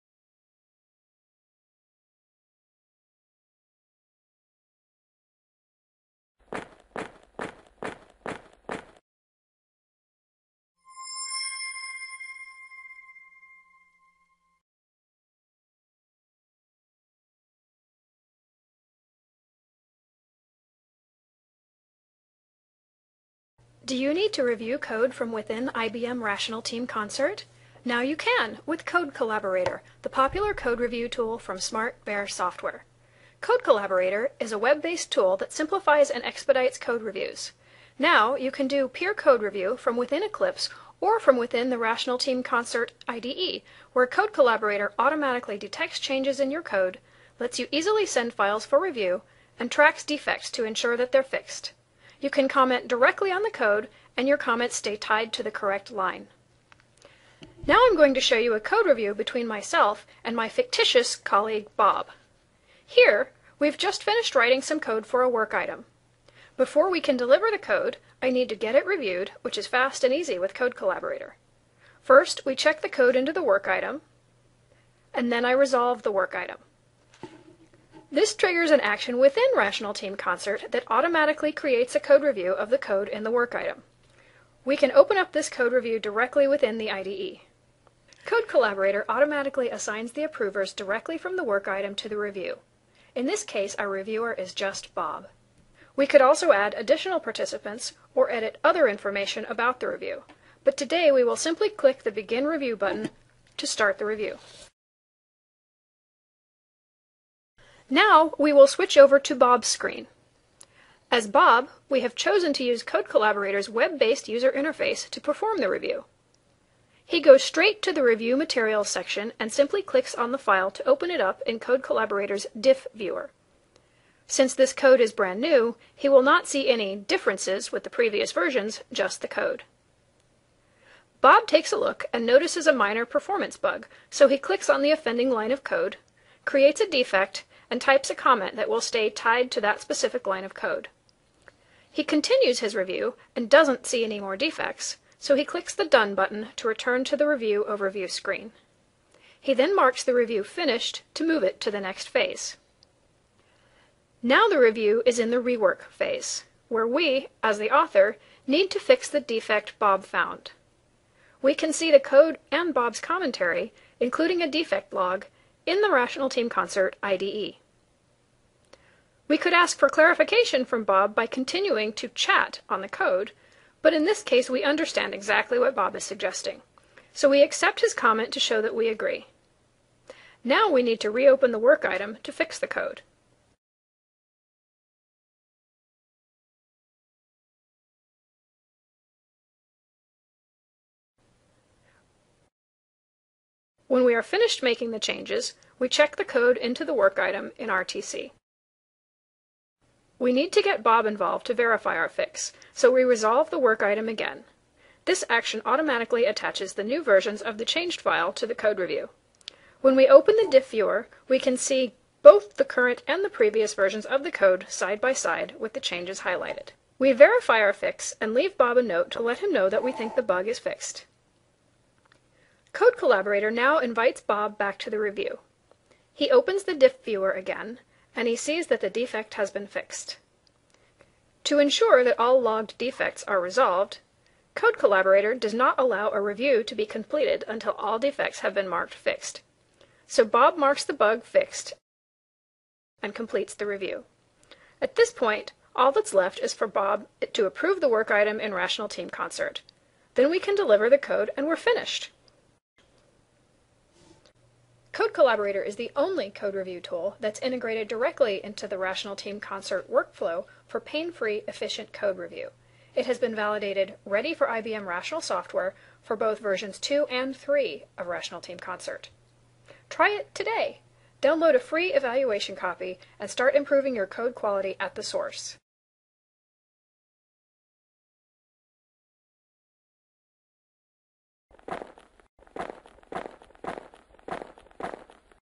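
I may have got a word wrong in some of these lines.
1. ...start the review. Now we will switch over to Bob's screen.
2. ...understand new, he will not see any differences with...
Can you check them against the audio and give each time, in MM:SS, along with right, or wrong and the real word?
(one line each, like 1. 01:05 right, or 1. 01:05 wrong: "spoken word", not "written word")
1. 01:43 right
2. 02:05 wrong: "brand", not "understand".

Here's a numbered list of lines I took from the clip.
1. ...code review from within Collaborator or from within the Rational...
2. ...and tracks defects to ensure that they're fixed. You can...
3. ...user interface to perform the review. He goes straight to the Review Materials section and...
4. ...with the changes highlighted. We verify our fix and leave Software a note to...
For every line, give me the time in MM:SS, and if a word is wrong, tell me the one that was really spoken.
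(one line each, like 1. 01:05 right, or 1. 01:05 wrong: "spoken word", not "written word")
1. 00:39 wrong: "Eclipse", not "Collaborator"
2. 00:49 right
3. 01:54 right
4. 03:35 wrong: "Bob", not "Software".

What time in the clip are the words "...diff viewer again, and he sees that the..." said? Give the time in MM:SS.
03:46.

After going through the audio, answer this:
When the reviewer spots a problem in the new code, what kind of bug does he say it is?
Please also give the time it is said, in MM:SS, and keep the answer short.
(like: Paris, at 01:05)
Minor performance bug, at 02:12.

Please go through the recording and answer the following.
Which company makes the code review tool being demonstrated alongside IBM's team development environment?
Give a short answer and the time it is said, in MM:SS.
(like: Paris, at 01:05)
SmartBear Software, at 00:31.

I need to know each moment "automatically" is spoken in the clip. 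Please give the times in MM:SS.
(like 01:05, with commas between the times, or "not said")
00:44, 01:20, 01:29, 03:25.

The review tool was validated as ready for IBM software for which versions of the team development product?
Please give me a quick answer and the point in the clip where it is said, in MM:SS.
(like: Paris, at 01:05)
2 and 3, at 04:26.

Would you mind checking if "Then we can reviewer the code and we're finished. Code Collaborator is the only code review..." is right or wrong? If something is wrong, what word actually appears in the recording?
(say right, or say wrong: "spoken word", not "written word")
wrong: "deliver", not "reviewer".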